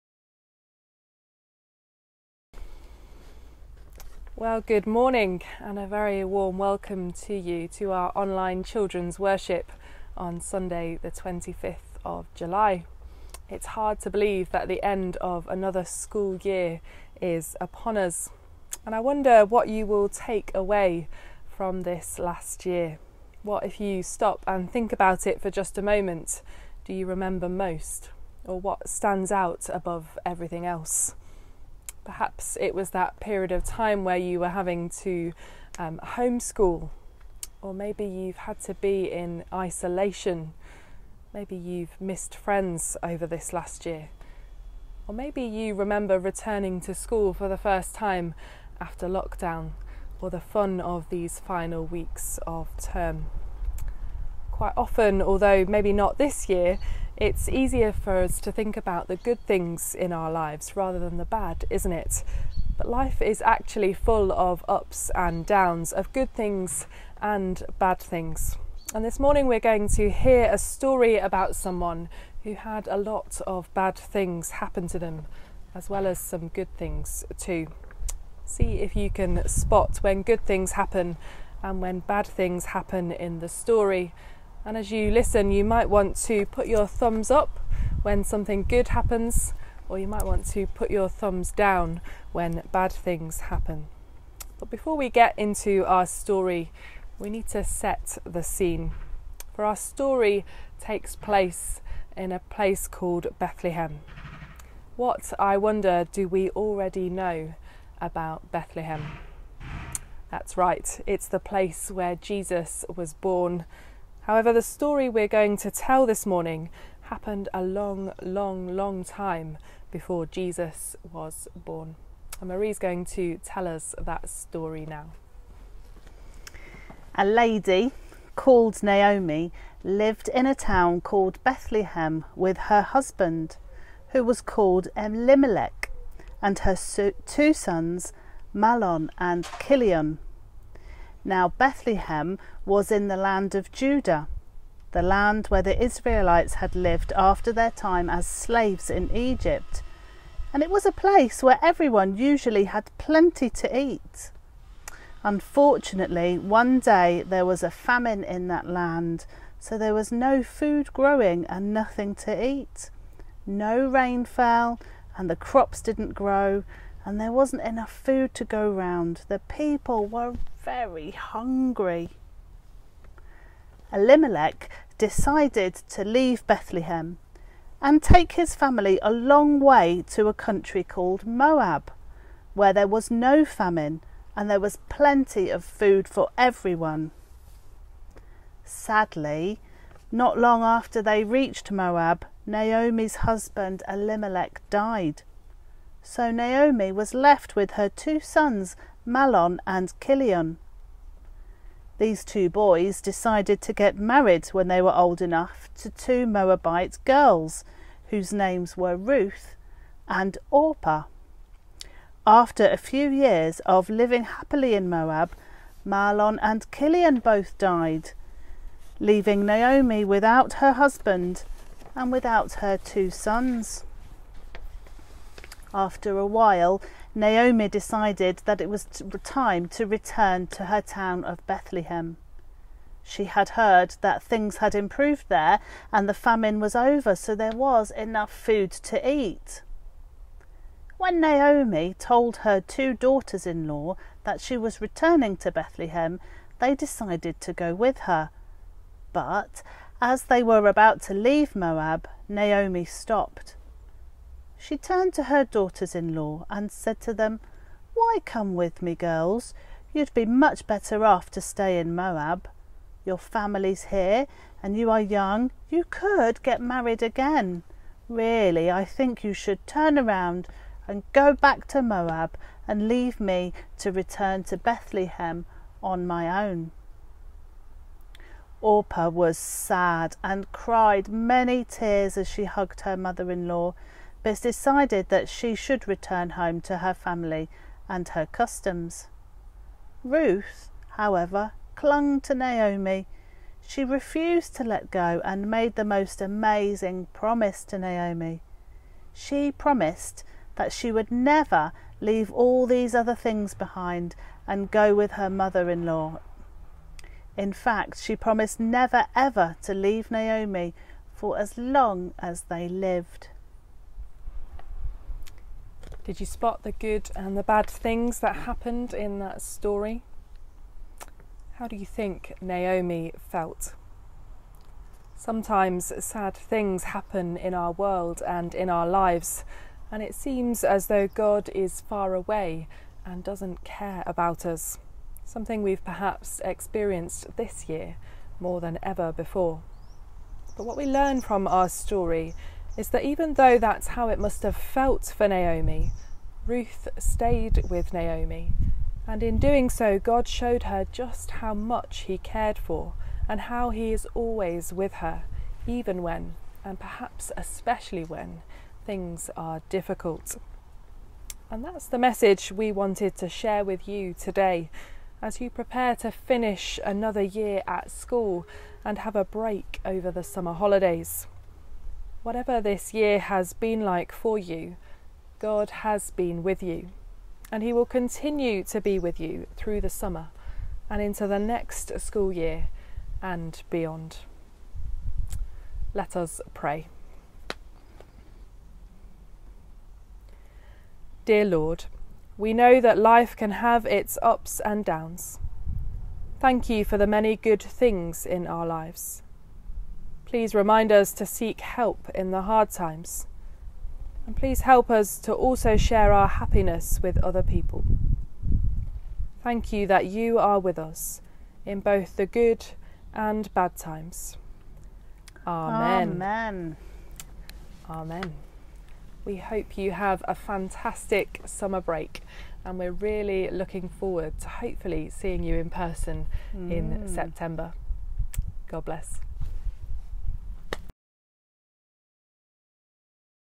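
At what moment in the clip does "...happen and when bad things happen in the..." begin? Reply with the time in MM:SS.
01:20.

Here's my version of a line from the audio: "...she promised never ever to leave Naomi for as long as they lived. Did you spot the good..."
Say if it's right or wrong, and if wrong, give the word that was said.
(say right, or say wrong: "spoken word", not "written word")
right.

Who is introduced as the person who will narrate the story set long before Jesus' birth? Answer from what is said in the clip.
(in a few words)
Marie.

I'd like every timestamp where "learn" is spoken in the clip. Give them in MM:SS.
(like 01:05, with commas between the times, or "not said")
05:40.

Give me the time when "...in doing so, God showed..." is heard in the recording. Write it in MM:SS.
05:49.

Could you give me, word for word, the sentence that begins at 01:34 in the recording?
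But before we get into our story, we need to set the scene.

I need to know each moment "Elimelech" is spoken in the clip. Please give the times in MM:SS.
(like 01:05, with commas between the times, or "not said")
02:14, 02:53, 03:13.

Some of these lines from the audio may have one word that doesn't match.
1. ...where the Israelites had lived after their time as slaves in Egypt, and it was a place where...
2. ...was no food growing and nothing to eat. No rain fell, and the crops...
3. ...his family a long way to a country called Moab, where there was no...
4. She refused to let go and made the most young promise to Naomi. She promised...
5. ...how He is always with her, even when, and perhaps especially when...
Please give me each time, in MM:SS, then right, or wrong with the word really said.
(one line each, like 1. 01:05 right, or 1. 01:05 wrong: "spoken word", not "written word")
1. 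02:25 right
2. 02:39 right
3. 02:58 right
4. 04:53 wrong: "amazing", not "young"
5. 05:53 right.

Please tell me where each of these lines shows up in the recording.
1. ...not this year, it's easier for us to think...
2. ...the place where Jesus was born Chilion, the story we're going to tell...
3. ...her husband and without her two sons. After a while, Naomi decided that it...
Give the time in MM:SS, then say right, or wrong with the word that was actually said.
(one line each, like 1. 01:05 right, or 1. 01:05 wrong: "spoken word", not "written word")
1. 00:55 right
2. 01:51 wrong: "However", not "Chilion"
3. 03:40 right.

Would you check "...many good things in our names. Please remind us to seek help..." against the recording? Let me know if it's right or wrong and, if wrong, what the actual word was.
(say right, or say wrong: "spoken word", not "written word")
wrong: "lives", not "names".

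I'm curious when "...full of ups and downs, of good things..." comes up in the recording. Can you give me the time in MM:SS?
01:03.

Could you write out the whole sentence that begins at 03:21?
These two boys decided to get married when they were old enough to two Moabite girls whose names were Ruth and Orpah.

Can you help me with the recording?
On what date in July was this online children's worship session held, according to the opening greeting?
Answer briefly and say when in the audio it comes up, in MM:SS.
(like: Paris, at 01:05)
25th, at 00:10.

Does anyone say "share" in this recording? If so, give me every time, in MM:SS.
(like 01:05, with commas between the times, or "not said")
06:03, 06:45.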